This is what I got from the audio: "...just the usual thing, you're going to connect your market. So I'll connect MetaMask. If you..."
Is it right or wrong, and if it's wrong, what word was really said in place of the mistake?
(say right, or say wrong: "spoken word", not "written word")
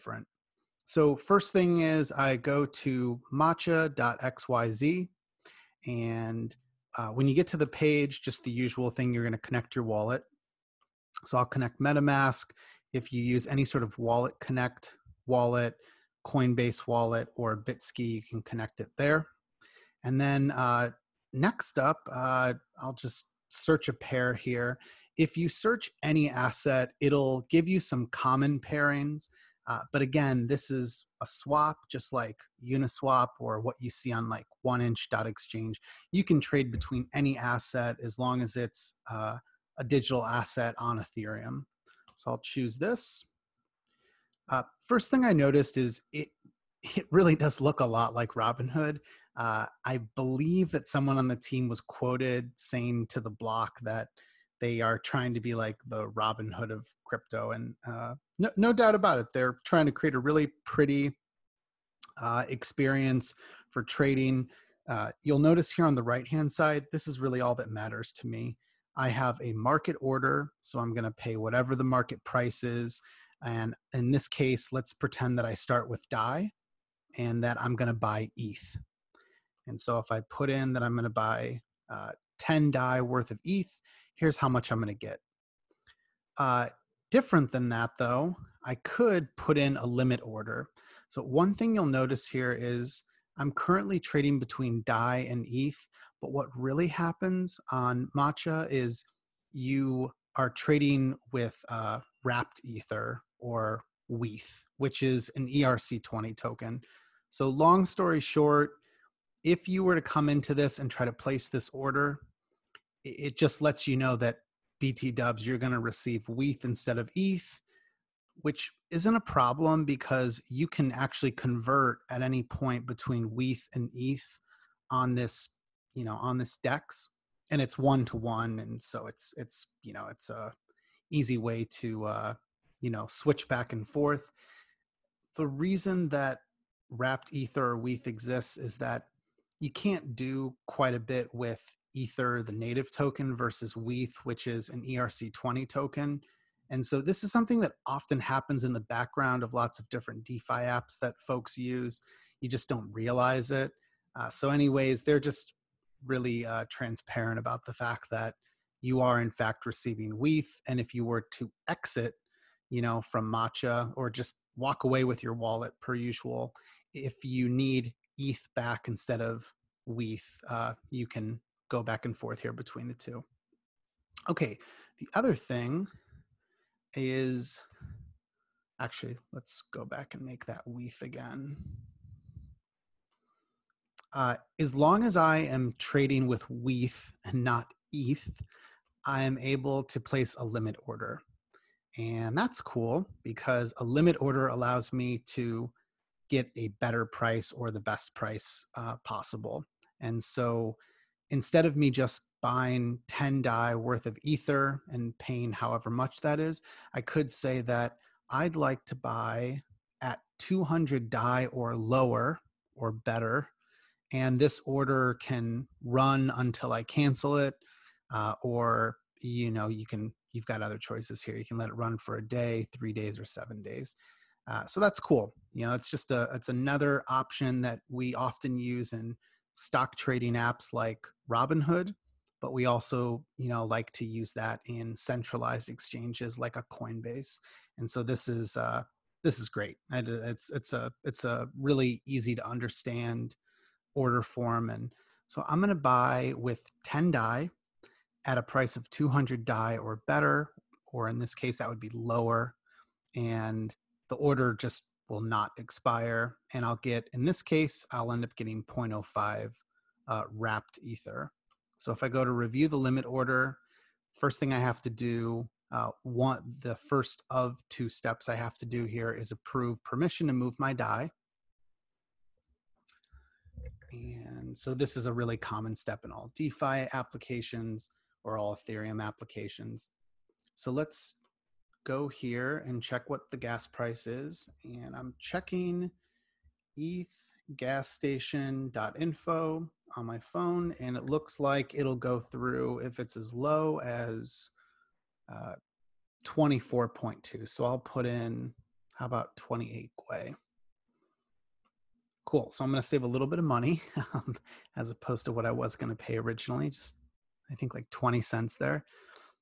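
wrong: "wallet", not "market".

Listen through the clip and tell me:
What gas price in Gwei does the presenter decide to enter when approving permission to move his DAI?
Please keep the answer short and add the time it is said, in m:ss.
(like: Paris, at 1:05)
28 Gwei, at 4:59.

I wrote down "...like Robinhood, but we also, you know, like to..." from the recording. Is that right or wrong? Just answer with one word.
right.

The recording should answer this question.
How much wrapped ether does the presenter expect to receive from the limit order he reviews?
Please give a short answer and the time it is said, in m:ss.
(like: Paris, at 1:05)
0.05, at 4:18.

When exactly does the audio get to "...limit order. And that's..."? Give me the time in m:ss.
3:10.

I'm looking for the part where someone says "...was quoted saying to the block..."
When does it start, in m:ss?
0:51.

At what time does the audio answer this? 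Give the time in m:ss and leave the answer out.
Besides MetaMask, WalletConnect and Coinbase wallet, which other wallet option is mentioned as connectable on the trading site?
0:17.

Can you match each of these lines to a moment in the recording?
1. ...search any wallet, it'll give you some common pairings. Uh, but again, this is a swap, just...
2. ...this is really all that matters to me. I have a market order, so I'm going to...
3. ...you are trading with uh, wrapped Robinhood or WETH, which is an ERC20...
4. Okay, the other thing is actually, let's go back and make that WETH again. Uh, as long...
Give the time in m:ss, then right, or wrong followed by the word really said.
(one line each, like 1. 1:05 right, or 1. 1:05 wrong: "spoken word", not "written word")
1. 0:25 wrong: "asset", not "wallet"
2. 1:06 right
3. 1:39 wrong: "Ether", not "Robinhood"
4. 2:54 right.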